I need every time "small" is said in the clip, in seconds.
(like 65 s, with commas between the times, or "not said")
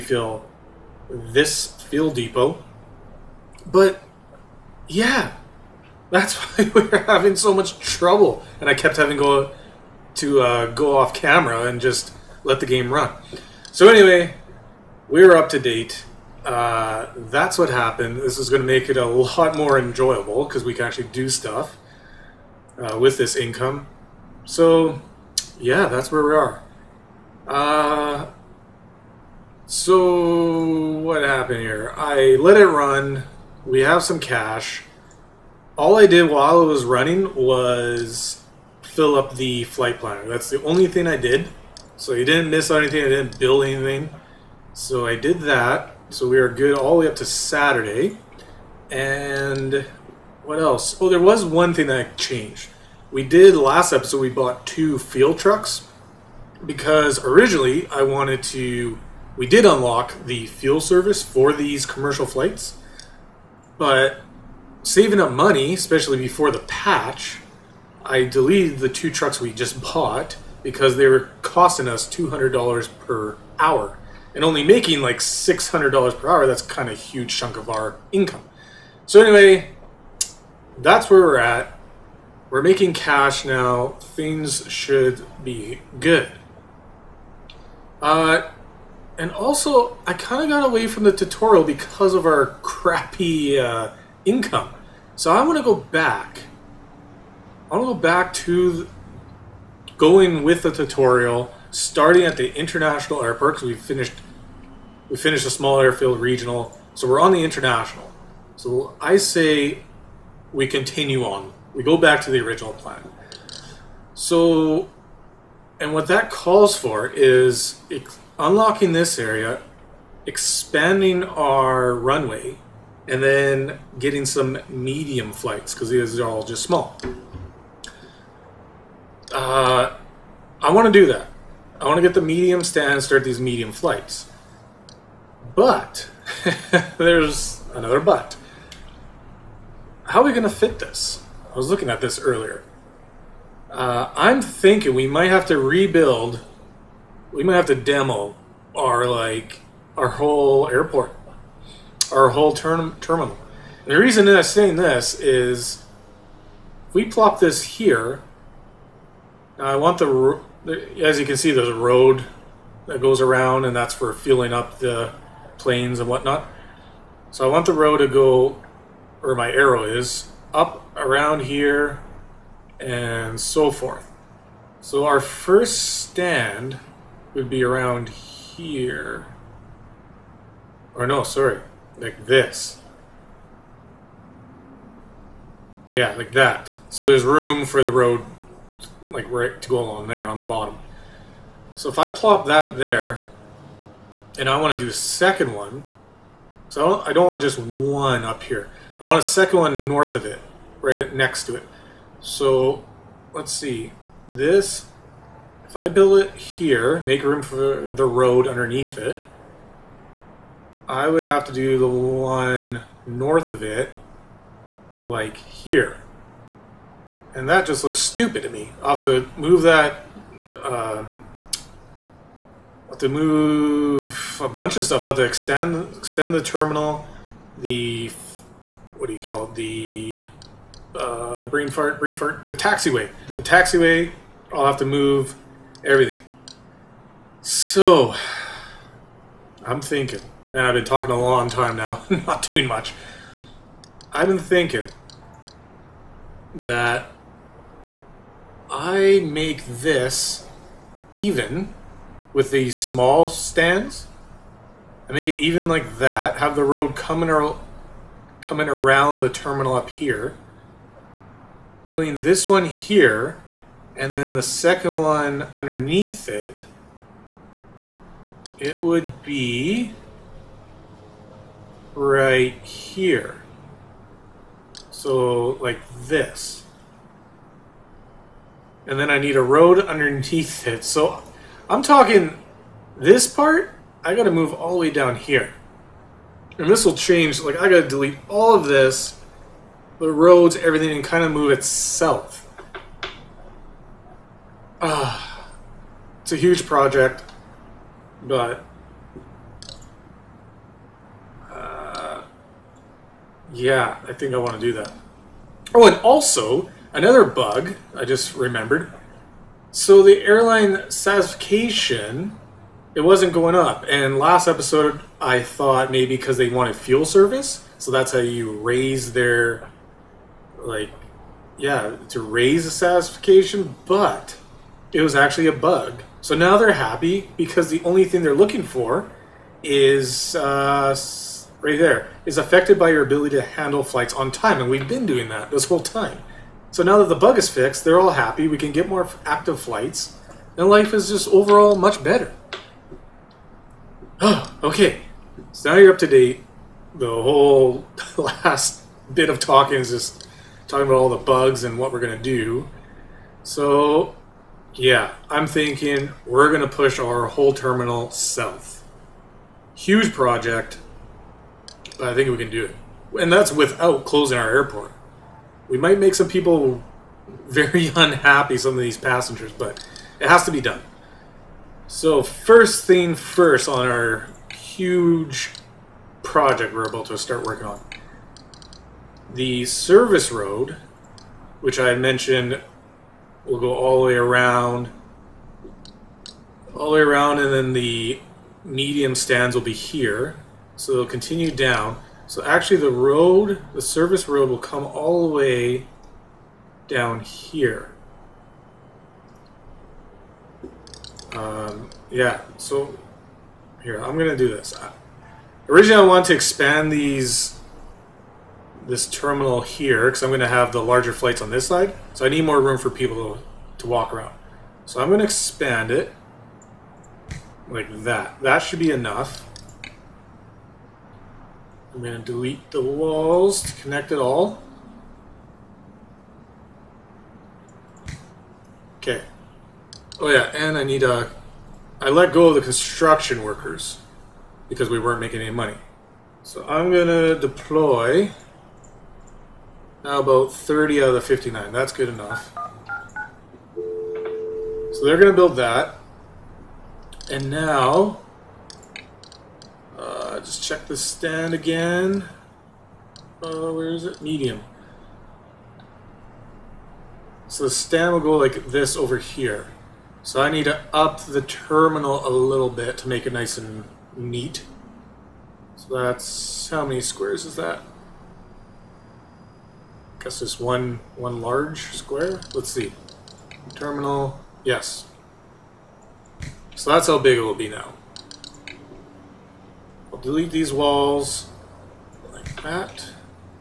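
105 s, 126 s, 252 s.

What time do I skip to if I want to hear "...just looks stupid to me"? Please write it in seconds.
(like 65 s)
217 s.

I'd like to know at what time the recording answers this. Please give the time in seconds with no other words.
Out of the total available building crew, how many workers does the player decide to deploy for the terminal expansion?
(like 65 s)
440 s.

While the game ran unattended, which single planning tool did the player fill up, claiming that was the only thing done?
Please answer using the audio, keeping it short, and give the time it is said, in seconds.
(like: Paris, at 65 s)
flight planner, at 39 s.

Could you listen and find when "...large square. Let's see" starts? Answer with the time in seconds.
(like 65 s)
471 s.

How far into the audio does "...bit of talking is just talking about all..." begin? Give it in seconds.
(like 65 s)
349 s.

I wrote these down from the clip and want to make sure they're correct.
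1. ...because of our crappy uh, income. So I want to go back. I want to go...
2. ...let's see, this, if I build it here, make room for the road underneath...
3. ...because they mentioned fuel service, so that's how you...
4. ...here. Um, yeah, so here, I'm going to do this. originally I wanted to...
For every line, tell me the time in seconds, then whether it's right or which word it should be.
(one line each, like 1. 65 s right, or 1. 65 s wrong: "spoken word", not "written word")
1. 91 s right
2. 203 s right
3. 316 s wrong: "wanted", not "mentioned"
4. 397 s right.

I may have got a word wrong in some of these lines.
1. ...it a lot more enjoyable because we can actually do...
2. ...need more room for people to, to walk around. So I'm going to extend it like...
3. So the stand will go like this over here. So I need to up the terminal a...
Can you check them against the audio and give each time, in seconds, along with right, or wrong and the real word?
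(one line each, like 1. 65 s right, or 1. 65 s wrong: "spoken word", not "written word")
1. 18 s right
2. 412 s wrong: "expand", not "extend"
3. 457 s right.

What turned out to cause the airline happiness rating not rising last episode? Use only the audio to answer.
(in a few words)
a bug.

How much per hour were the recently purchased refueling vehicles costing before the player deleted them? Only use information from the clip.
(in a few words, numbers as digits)
$200.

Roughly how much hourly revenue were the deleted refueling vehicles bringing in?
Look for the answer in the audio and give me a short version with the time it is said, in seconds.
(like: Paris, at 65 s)
$600, at 75 s.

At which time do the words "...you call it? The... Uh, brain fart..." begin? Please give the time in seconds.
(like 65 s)
229 s.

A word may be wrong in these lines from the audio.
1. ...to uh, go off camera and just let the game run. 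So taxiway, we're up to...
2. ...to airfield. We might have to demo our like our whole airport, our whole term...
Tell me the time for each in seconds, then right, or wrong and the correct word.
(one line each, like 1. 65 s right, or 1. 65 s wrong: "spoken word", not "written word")
1. 10 s wrong: "anyway", not "taxiway"
2. 145 s wrong: "rebuild", not "airfield".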